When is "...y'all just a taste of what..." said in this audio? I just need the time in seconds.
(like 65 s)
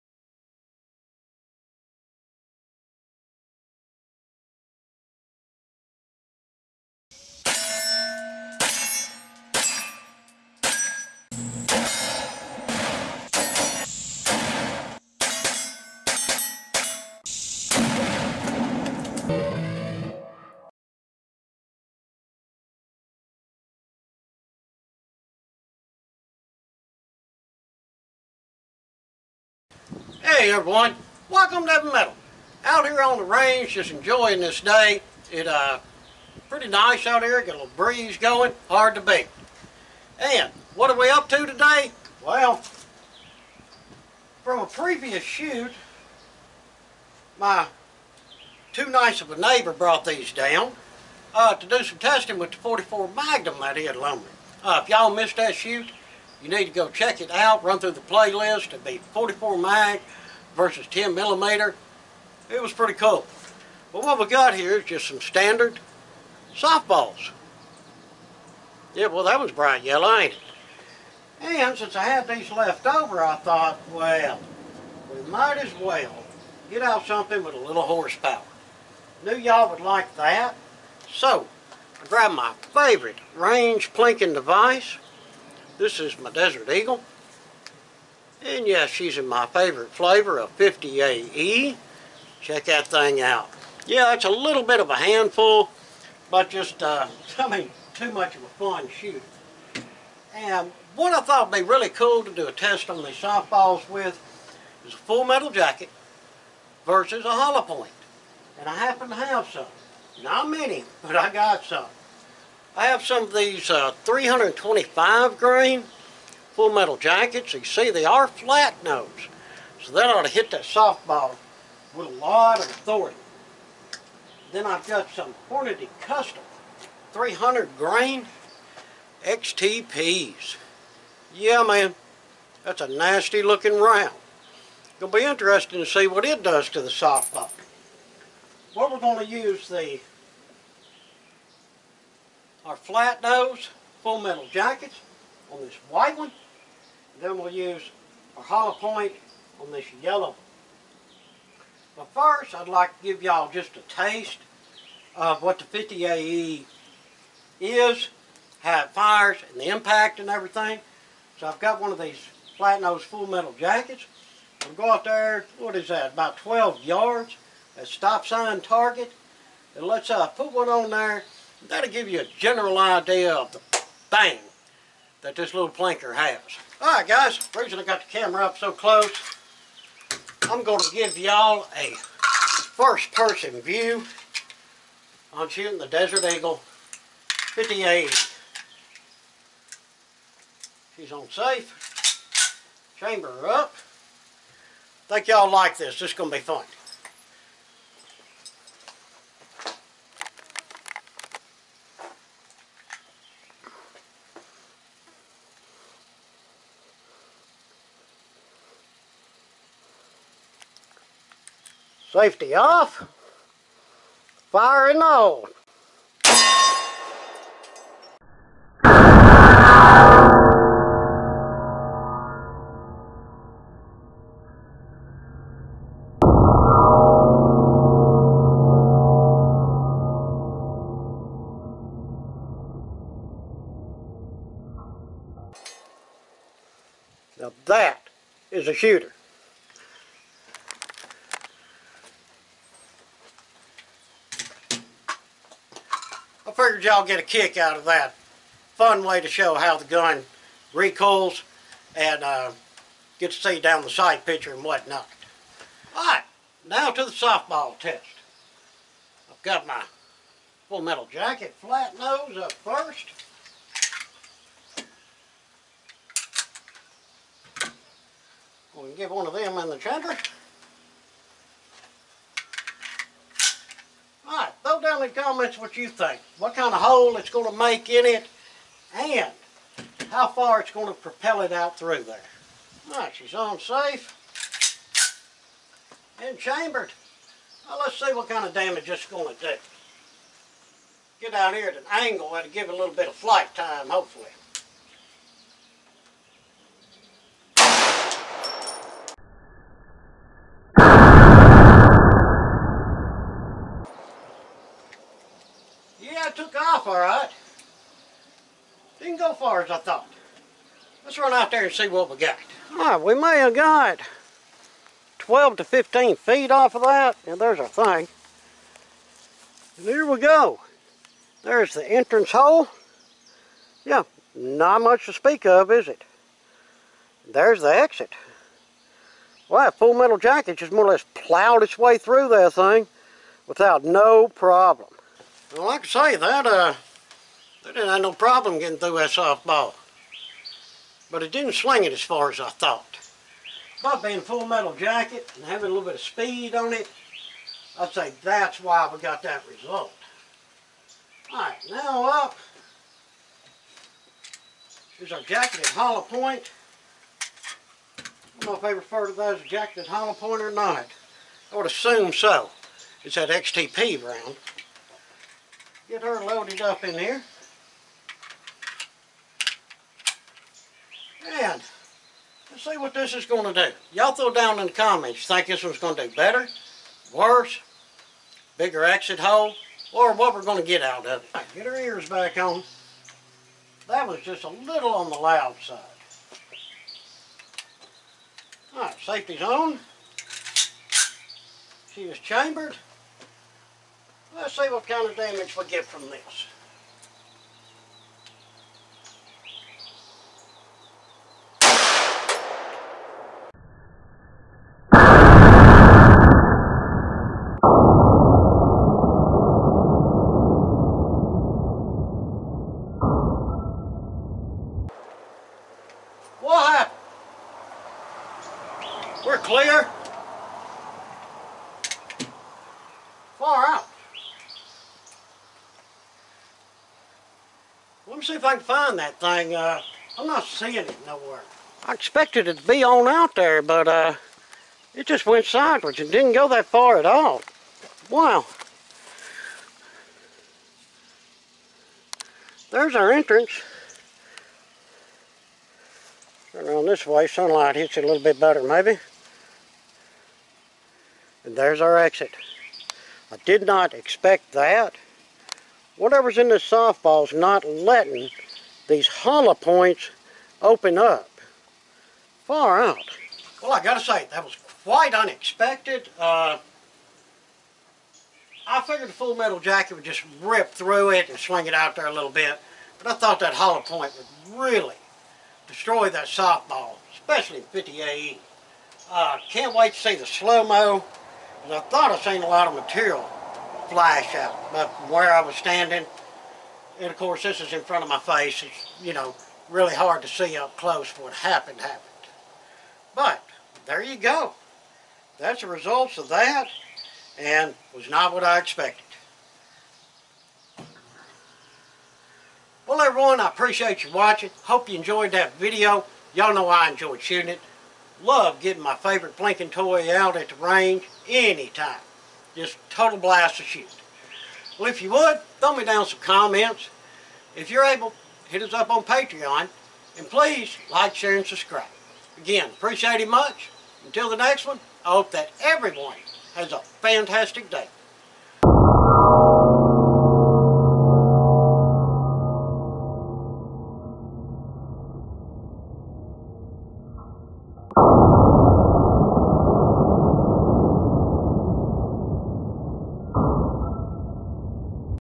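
153 s.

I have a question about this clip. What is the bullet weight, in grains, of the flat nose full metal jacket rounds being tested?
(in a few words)
325.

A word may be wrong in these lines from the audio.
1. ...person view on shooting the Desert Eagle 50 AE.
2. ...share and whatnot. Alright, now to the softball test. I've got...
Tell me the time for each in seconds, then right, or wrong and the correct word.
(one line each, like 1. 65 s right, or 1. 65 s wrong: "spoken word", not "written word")
1. 183 s right
2. 254 s wrong: "picture", not "share".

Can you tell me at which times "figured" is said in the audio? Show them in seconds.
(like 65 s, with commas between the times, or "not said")
246 s, 468 s.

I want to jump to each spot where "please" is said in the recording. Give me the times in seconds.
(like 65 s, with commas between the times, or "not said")
520 s.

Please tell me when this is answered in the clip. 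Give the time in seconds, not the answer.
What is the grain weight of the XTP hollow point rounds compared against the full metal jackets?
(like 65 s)
127 s.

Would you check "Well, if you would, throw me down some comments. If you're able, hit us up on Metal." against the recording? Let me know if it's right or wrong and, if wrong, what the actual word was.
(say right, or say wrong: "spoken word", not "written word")
wrong: "Patreon", not "Metal".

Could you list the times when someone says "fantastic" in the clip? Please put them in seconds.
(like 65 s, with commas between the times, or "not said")
526 s.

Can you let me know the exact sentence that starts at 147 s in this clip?
Then we'll use our hollow point on this yellow.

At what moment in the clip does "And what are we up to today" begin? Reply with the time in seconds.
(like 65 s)
40 s.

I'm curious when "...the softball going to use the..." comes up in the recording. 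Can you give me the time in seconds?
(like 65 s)
136 s.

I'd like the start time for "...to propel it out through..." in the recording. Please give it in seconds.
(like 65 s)
280 s.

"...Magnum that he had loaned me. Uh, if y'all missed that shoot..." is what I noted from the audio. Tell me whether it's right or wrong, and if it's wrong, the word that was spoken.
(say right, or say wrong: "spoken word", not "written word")
right.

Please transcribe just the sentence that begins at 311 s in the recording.
Let's run out there and see what we got.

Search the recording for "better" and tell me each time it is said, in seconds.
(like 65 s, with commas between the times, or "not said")
376 s, 448 s.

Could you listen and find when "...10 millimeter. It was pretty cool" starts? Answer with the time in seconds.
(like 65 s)
60 s.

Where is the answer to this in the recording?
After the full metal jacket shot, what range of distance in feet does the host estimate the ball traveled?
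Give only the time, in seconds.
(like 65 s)
315 s.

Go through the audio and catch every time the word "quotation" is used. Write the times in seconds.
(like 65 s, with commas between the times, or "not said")
not said.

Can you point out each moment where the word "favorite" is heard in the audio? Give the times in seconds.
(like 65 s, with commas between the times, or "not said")
82 s, 89 s, 508 s.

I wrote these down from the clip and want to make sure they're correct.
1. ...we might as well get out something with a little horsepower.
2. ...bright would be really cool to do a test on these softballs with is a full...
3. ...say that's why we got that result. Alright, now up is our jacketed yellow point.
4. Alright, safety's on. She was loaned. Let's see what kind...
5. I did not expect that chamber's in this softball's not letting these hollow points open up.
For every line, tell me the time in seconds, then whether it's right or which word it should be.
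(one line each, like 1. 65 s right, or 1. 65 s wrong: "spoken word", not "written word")
1. 75 s right
2. 101 s wrong: "thought", not "bright"
3. 347 s wrong: "hollow", not "yellow"
4. 388 s wrong: "chambered", not "loaned"
5. 453 s wrong: "whatever", not "chamber".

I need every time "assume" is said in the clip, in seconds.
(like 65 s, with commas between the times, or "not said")
361 s.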